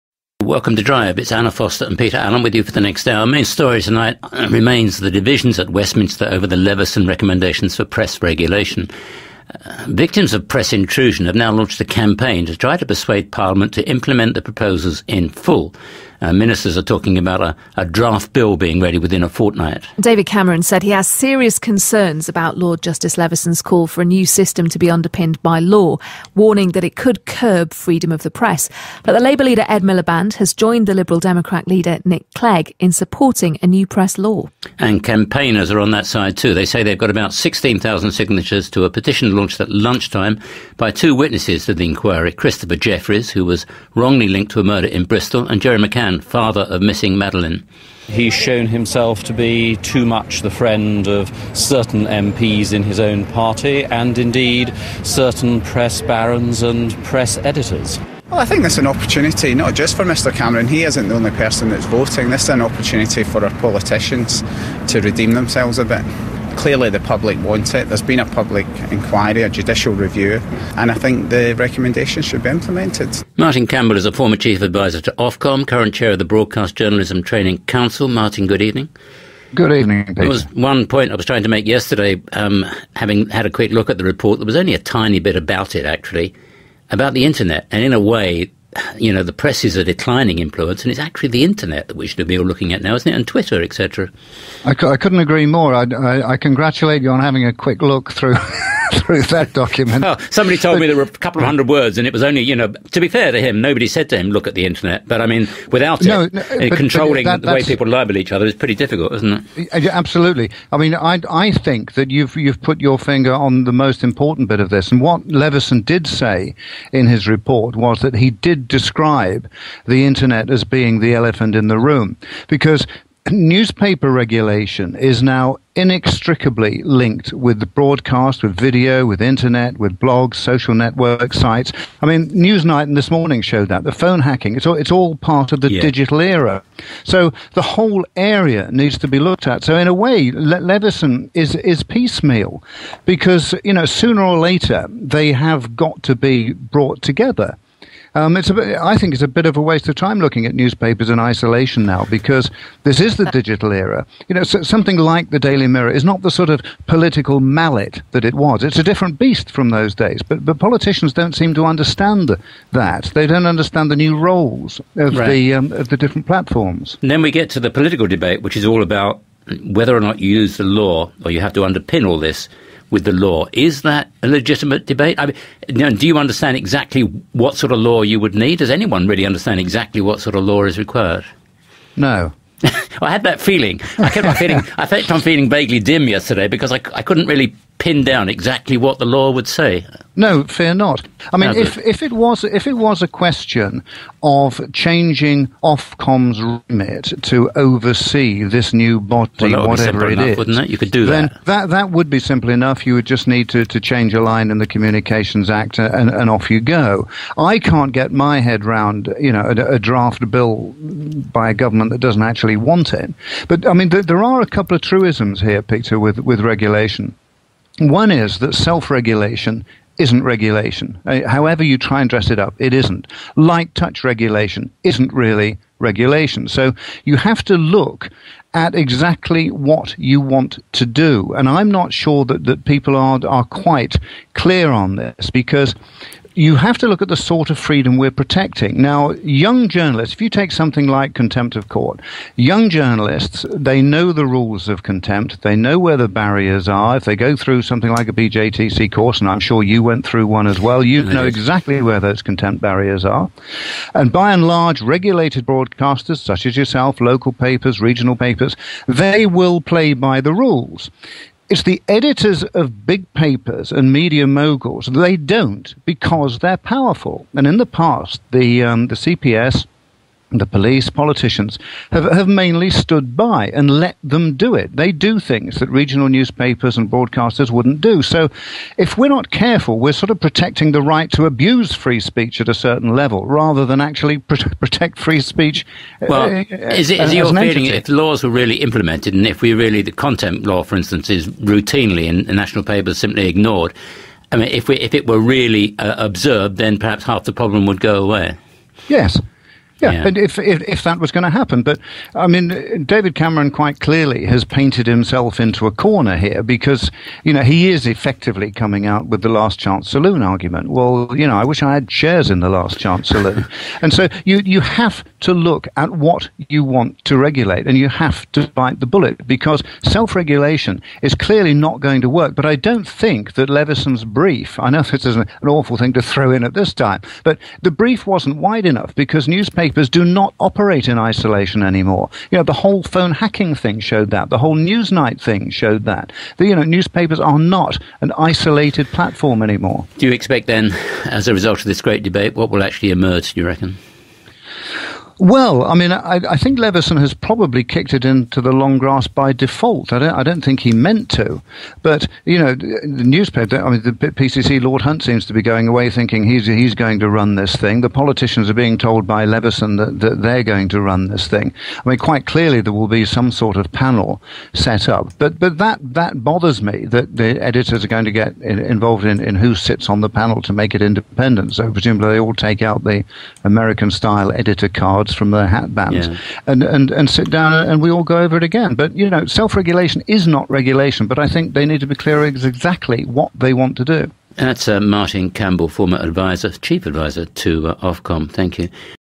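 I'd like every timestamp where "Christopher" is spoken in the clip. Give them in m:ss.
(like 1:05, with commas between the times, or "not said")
0:42.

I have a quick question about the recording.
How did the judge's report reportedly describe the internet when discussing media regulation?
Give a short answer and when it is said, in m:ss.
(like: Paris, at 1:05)
The elephant in the room, at 2:00.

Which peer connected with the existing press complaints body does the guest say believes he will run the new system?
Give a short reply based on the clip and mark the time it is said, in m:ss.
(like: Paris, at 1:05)
Lord Hunt, at 5:54.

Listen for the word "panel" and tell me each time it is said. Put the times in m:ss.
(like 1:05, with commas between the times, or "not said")
6:03, 6:10.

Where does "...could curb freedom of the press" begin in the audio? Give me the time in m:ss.
0:26.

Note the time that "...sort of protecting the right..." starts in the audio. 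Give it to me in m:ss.
4:39.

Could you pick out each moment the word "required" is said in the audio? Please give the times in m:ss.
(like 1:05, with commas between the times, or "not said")
3:00.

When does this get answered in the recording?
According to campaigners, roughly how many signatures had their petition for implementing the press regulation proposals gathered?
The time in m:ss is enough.
0:37.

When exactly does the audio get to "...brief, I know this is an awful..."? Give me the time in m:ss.
5:24.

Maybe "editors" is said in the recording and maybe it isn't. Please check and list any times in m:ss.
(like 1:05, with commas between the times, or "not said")
0:57, 4:21, 6:07, 6:14.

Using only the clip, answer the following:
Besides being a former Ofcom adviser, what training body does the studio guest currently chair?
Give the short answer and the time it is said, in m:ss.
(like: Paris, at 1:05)
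Broadcast Journalism Training Council, at 1:16.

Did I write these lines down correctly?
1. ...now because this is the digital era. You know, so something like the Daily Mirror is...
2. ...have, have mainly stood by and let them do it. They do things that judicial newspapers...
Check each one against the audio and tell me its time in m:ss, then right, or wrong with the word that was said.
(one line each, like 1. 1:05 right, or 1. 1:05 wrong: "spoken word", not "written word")
1. 2:31 right
2. 4:31 wrong: "regional", not "judicial".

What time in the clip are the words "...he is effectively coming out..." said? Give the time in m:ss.
5:07.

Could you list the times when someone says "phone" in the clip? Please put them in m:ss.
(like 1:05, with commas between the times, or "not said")
2:13, 5:32.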